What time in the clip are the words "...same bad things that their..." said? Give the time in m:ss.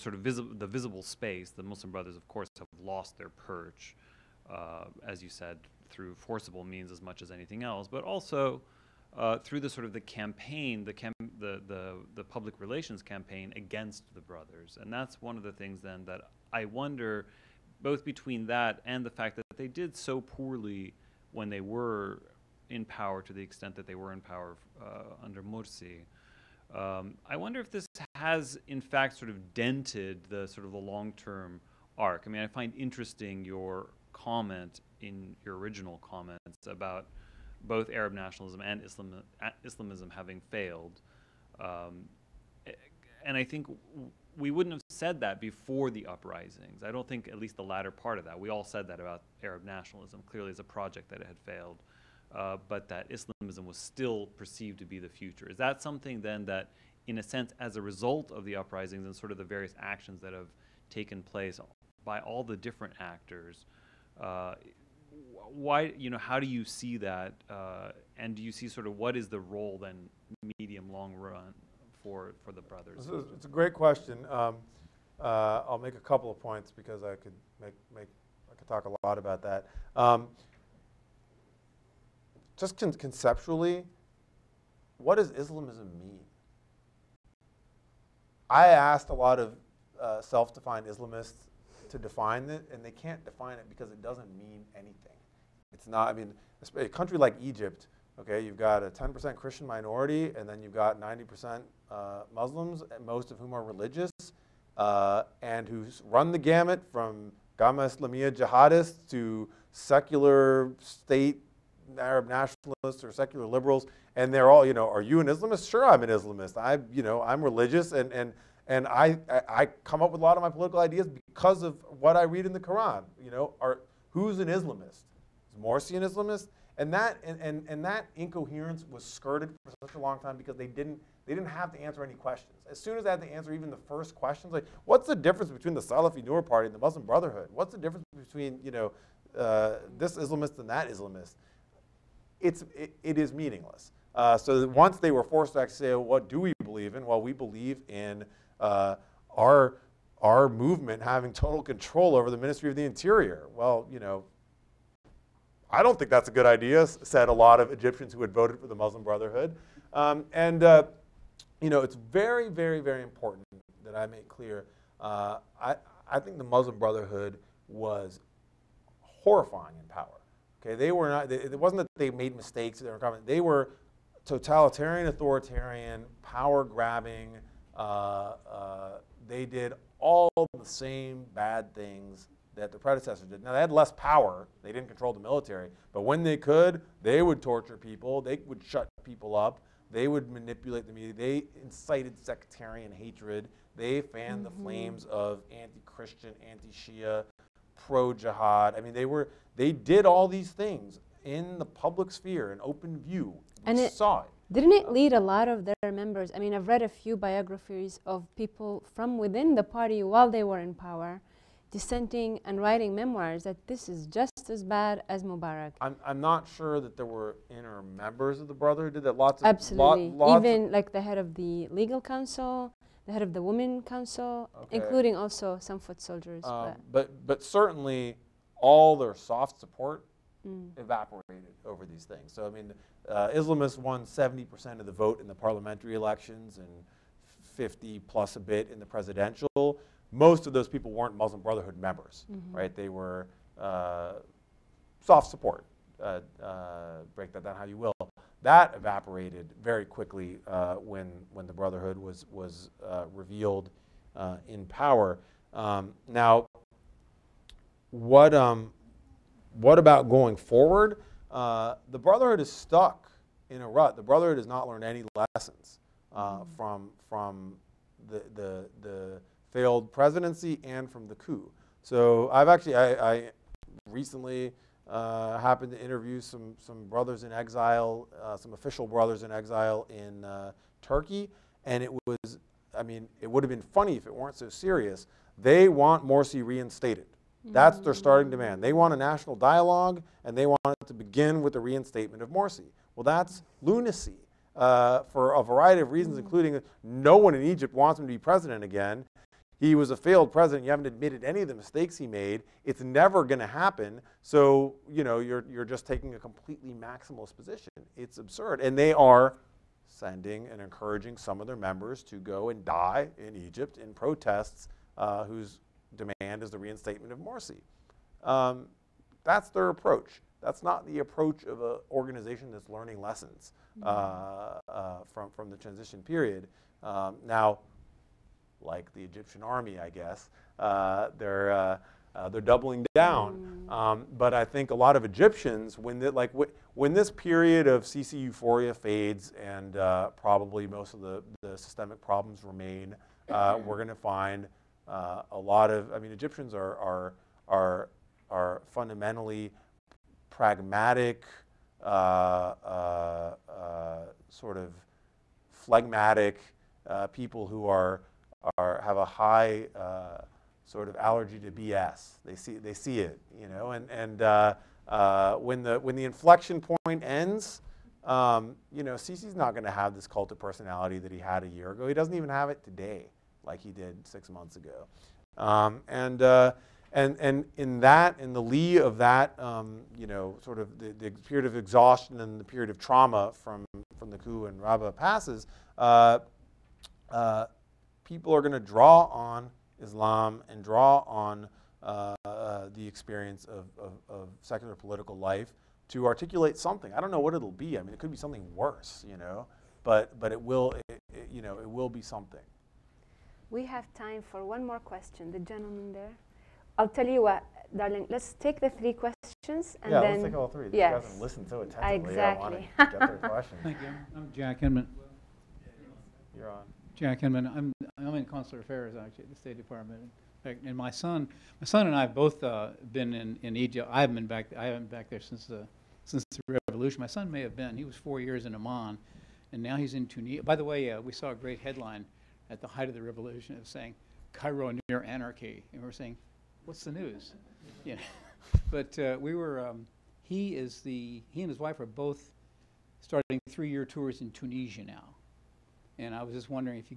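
3:00.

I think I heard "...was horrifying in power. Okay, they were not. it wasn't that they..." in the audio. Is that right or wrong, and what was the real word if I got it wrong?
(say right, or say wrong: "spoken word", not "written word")
right.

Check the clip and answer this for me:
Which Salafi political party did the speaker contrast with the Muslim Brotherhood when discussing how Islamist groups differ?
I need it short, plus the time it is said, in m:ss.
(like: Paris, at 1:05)
Noor Party, at 2:16.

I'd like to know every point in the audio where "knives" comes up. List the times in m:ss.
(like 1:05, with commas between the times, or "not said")
not said.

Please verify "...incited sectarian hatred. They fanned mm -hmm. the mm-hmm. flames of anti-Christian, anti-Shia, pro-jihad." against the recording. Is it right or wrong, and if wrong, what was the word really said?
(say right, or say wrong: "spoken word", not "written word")
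right.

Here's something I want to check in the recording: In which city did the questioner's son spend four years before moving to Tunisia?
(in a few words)
Amman.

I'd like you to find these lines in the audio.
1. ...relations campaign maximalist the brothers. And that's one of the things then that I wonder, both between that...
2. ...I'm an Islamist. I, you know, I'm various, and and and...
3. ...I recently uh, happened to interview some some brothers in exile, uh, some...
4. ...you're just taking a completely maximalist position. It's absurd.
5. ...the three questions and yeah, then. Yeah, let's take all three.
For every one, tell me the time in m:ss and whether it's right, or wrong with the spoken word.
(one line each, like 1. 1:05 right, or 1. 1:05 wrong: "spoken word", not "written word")
1. 0:12 wrong: "against", not "maximalist"
2. 1:55 wrong: "religious", not "various"
3. 4:33 right
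4. 5:05 right
5. 6:48 right.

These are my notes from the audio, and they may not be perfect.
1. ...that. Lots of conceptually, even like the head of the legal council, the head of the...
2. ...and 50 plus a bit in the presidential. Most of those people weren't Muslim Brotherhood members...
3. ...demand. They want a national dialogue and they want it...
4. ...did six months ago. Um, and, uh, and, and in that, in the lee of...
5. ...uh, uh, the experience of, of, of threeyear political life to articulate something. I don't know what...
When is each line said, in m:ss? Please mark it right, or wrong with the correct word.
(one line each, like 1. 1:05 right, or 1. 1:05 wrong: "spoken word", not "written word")
1. 3:39 wrong: "absolutely", not "conceptually"
2. 3:56 right
3. 4:48 right
4. 6:13 right
5. 6:31 wrong: "secular", not "threeyear".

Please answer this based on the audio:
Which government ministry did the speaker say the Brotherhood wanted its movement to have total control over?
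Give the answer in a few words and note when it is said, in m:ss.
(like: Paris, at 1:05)
Ministry of the Interior, at 2:32.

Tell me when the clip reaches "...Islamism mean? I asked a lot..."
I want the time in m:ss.
1:25.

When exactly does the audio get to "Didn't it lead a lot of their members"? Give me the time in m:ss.
3:24.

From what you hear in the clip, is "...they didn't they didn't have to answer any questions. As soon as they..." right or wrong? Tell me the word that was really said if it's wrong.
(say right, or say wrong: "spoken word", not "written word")
right.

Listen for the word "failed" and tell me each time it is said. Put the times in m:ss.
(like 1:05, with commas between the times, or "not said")
0:40, 0:51, 4:29, 4:59.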